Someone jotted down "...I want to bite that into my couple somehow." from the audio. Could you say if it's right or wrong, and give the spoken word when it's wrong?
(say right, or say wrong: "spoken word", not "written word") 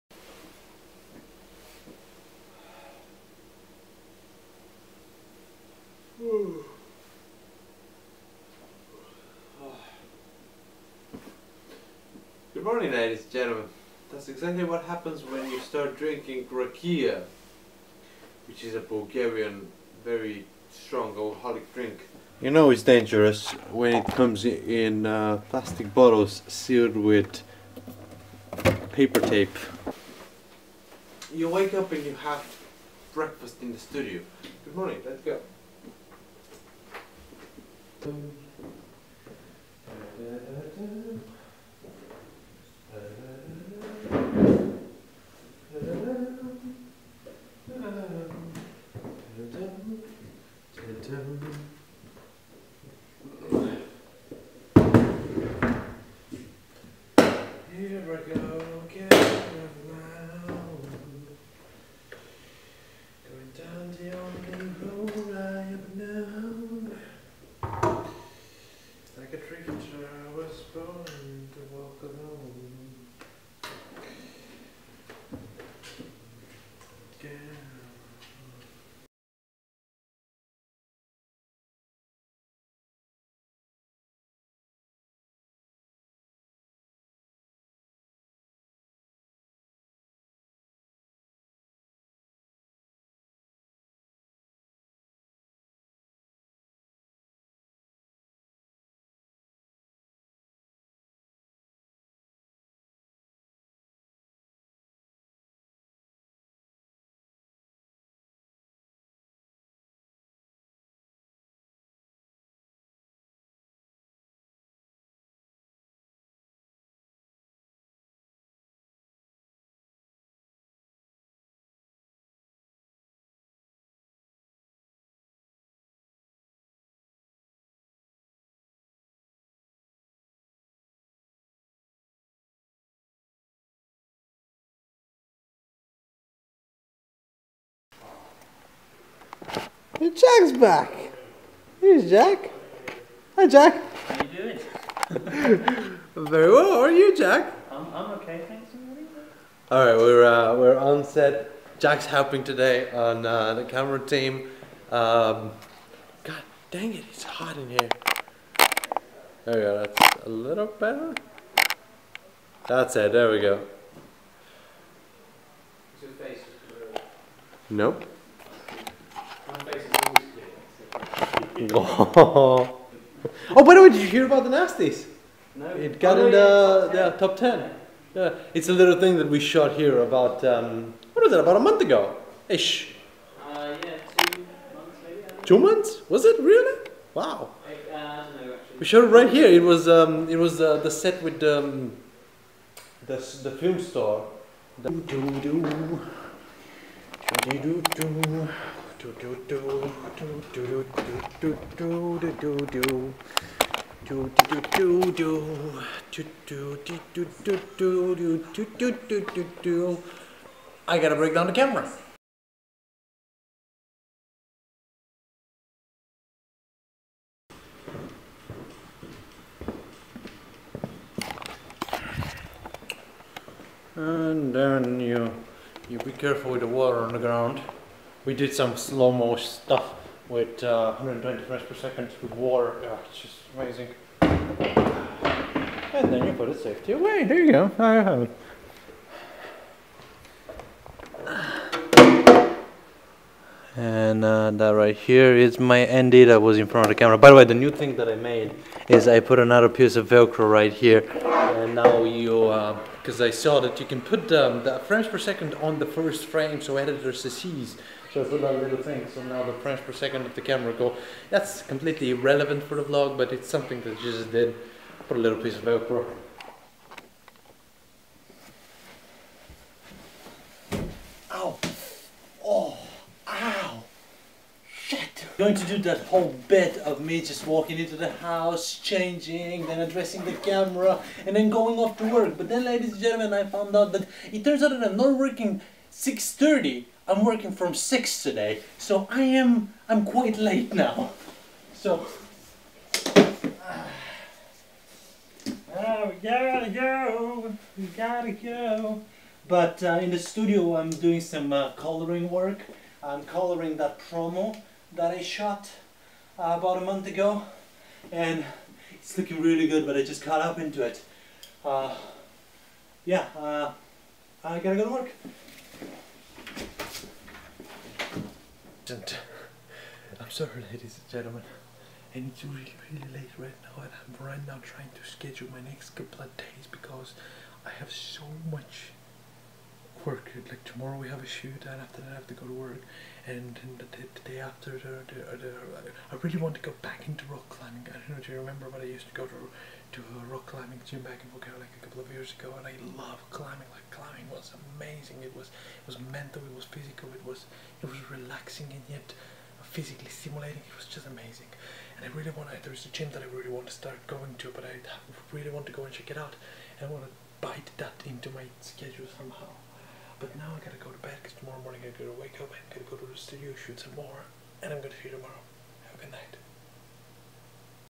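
wrong: "schedule", not "couple".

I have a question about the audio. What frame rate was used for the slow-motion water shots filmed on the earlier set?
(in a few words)
120 frames per second.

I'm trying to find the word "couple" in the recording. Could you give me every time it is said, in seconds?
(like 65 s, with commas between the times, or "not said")
325 s, 341 s.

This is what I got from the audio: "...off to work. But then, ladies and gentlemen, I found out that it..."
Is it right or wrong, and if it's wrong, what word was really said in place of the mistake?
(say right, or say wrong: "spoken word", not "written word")
right.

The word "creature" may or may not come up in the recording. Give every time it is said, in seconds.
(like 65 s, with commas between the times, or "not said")
69 s.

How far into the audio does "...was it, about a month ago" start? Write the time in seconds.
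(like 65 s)
181 s.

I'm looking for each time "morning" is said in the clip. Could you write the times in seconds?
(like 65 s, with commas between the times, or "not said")
12 s, 34 s, 361 s.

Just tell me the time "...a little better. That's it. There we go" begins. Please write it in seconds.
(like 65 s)
160 s.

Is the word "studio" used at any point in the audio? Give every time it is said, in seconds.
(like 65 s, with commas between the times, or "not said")
33 s, 300 s, 363 s.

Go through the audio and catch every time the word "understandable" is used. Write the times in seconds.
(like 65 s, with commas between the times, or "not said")
not said.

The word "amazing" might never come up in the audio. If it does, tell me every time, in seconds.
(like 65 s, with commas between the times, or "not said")
233 s, 344 s, 351 s.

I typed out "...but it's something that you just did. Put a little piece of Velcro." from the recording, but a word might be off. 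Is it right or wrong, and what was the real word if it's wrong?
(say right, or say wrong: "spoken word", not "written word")
right.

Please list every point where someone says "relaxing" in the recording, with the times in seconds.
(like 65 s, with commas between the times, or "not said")
348 s.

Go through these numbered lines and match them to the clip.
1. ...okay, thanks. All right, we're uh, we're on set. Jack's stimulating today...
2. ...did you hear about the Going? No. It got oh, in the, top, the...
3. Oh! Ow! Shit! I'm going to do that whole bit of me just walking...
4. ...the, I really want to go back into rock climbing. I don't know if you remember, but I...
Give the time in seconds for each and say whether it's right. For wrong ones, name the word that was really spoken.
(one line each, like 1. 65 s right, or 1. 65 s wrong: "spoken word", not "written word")
1. 148 s wrong: "helping", not "stimulating"
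2. 173 s wrong: "Nasties", not "Going"
3. 272 s right
4. 335 s right.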